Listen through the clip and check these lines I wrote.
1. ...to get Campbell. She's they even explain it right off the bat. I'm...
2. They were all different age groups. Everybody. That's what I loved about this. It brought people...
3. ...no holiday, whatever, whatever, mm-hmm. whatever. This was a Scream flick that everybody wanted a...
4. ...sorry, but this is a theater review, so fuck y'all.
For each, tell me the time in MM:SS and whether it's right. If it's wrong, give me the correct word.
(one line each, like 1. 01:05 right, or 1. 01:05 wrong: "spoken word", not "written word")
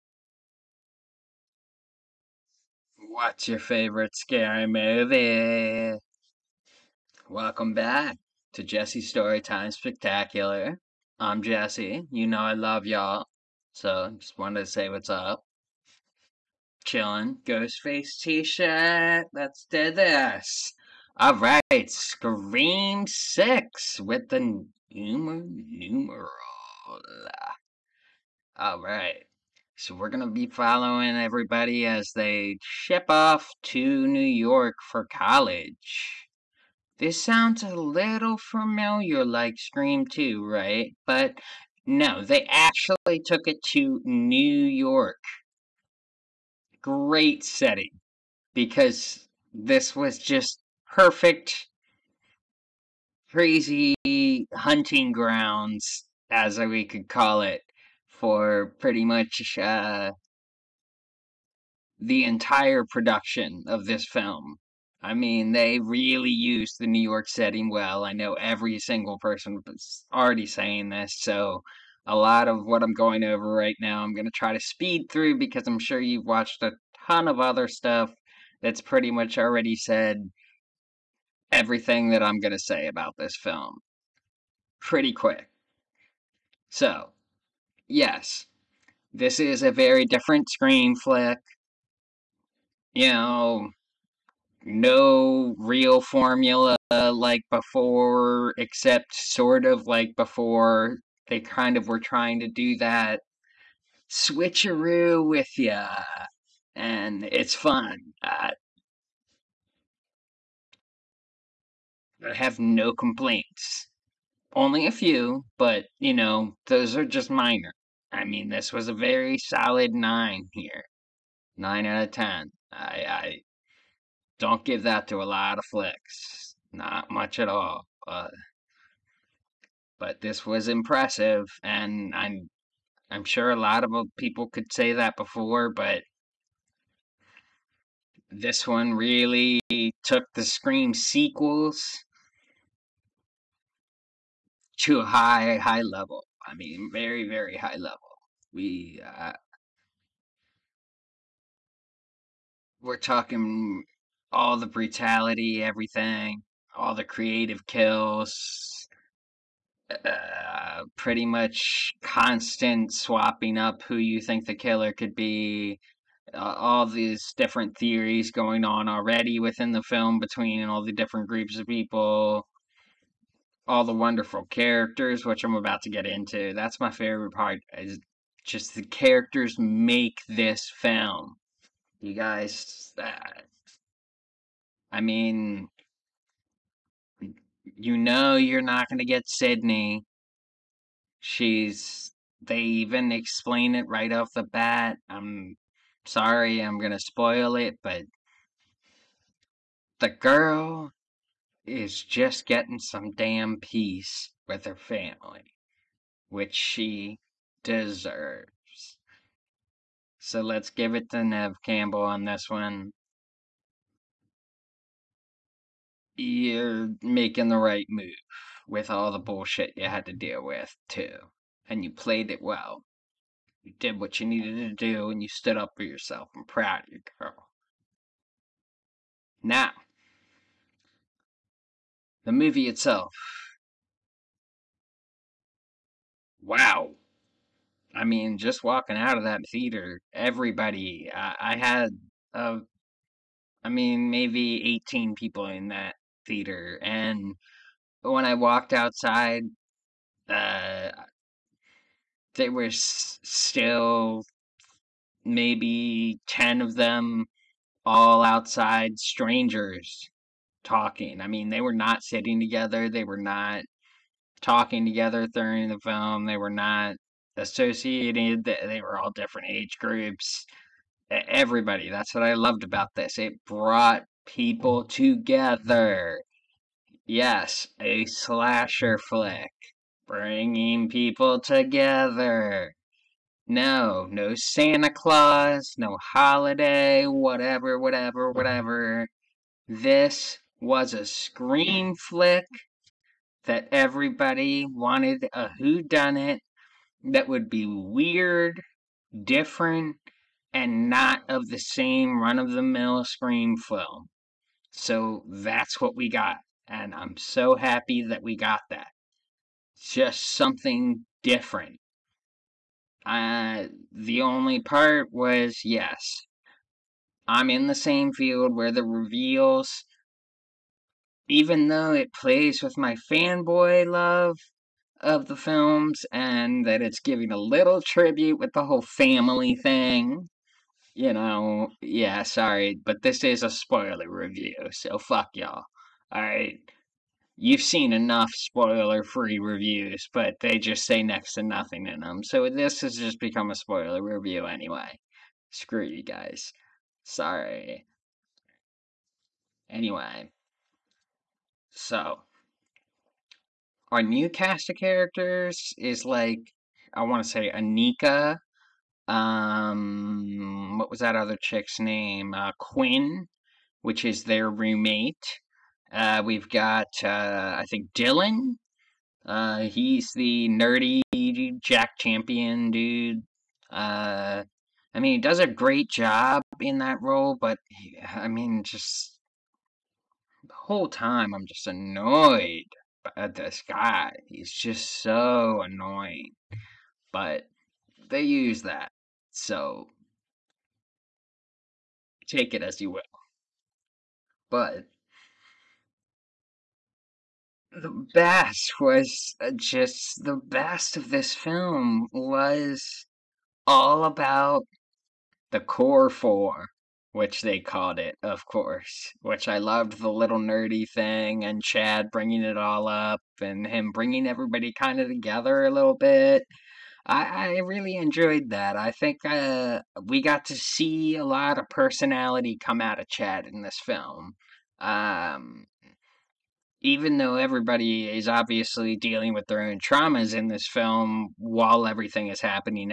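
1. 03:08 wrong: "Sidney", not "Campbell"
2. 04:28 right
3. 04:45 right
4. 05:32 wrong: "spoiler", not "theater".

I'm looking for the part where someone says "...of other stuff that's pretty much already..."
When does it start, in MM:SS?
01:17.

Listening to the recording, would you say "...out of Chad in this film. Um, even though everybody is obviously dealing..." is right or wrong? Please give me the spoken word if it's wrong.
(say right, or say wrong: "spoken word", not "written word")
right.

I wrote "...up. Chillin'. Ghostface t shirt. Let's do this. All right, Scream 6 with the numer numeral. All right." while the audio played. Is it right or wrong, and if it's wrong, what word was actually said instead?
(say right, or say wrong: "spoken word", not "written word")
right.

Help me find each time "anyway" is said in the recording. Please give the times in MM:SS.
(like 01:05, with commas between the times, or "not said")
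05:44, 05:49.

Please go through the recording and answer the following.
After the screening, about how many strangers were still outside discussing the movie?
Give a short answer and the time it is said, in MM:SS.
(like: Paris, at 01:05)
10, at 04:16.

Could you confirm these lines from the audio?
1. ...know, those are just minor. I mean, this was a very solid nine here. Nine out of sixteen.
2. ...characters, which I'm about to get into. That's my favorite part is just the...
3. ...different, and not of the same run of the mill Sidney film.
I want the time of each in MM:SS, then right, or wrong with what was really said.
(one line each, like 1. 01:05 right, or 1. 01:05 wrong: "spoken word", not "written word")
1. 01:56 wrong: "ten", not "sixteen"
2. 02:54 right
3. 04:59 wrong: "Scream", not "Sidney".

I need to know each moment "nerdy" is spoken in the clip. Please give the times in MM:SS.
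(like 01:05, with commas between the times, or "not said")
06:10, 06:50.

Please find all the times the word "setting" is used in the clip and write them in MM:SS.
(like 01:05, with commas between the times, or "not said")
00:47, 01:07.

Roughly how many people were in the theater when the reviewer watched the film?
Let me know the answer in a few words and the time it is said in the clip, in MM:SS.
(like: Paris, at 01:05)
18, at 04:04.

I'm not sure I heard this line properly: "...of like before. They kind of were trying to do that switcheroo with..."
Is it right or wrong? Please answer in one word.
right.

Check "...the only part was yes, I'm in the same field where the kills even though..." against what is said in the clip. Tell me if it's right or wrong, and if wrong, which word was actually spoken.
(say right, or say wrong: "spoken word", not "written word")
wrong: "reveals", not "kills".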